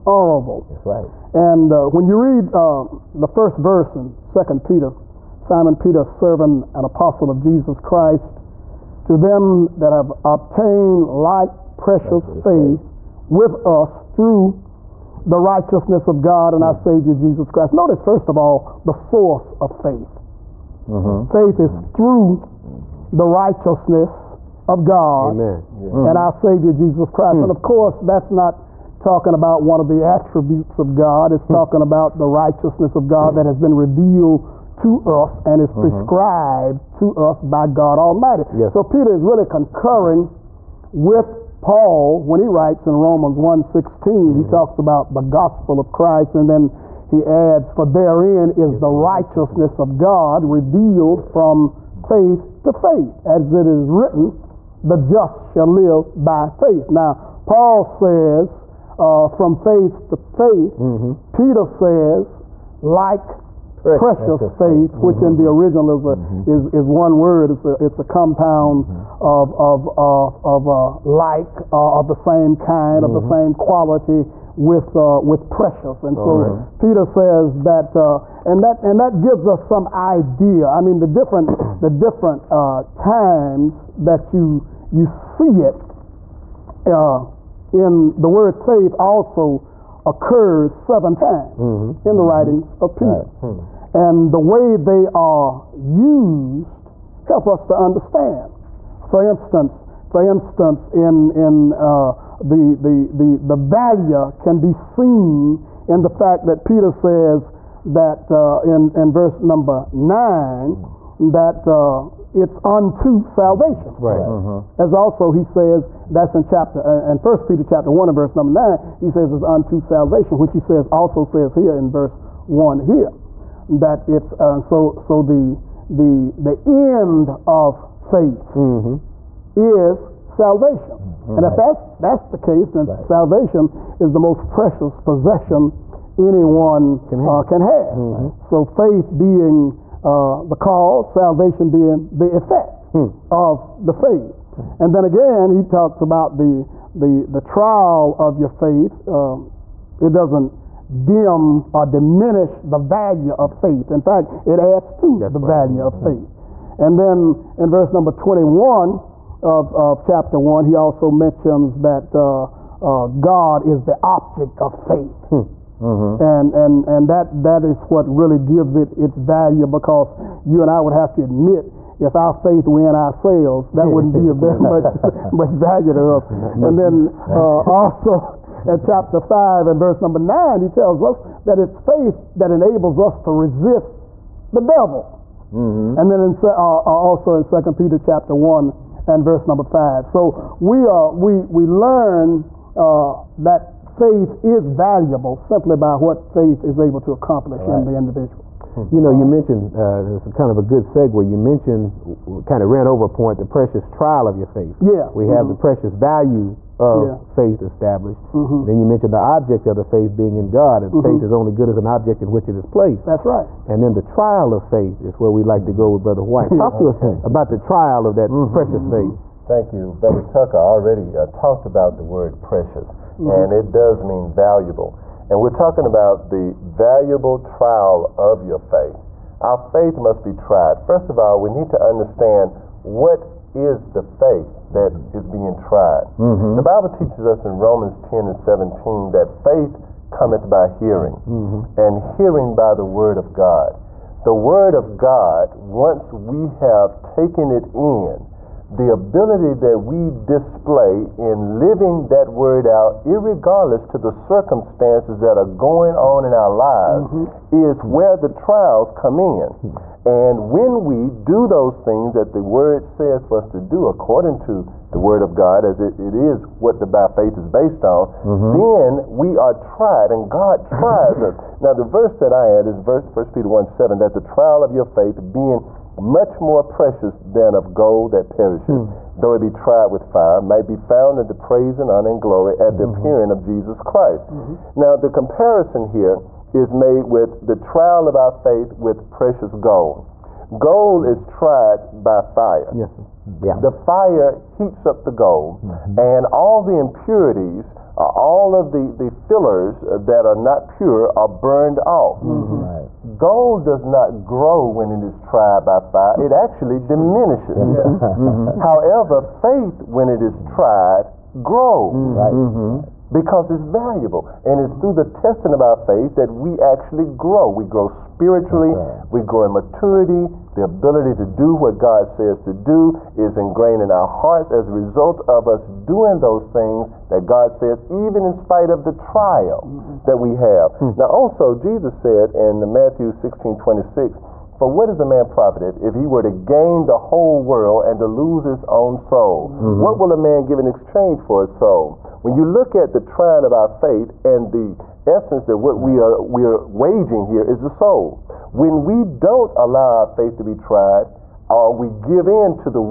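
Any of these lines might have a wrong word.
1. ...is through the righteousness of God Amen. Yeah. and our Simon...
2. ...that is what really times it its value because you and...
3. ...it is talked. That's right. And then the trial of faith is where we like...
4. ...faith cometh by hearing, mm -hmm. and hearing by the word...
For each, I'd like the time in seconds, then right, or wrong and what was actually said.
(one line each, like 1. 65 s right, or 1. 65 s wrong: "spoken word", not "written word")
1. 21 s wrong: "Savior", not "Simon"
2. 167 s wrong: "gives", not "times"
3. 212 s wrong: "placed", not "talked"
4. 239 s right.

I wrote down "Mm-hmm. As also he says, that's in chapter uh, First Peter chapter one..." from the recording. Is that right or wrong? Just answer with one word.
right.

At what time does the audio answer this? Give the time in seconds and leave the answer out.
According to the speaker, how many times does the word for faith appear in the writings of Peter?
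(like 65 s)
90 s.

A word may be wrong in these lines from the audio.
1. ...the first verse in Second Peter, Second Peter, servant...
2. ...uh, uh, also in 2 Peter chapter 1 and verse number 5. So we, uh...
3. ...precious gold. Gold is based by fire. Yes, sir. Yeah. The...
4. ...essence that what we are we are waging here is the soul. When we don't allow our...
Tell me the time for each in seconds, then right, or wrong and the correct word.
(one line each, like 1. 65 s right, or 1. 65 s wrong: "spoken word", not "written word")
1. 3 s wrong: "Simon", not "Second"
2. 186 s right
3. 289 s wrong: "tried", not "based"
4. 345 s right.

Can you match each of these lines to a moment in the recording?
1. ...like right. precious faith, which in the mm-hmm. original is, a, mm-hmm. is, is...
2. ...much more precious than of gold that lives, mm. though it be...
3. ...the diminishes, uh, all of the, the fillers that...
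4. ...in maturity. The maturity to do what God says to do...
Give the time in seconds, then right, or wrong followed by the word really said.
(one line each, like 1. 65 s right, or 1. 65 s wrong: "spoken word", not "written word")
1. 62 s right
2. 275 s wrong: "perishes", not "lives"
3. 296 s wrong: "impurities", not "diminishes"
4. 319 s wrong: "ability", not "maturity".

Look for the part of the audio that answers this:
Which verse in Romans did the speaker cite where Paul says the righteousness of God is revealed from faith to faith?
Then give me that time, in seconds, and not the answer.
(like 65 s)
42 s.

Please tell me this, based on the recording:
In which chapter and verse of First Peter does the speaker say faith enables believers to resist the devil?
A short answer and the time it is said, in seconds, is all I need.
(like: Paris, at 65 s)
Chapter 5, verse 9, at 178 s.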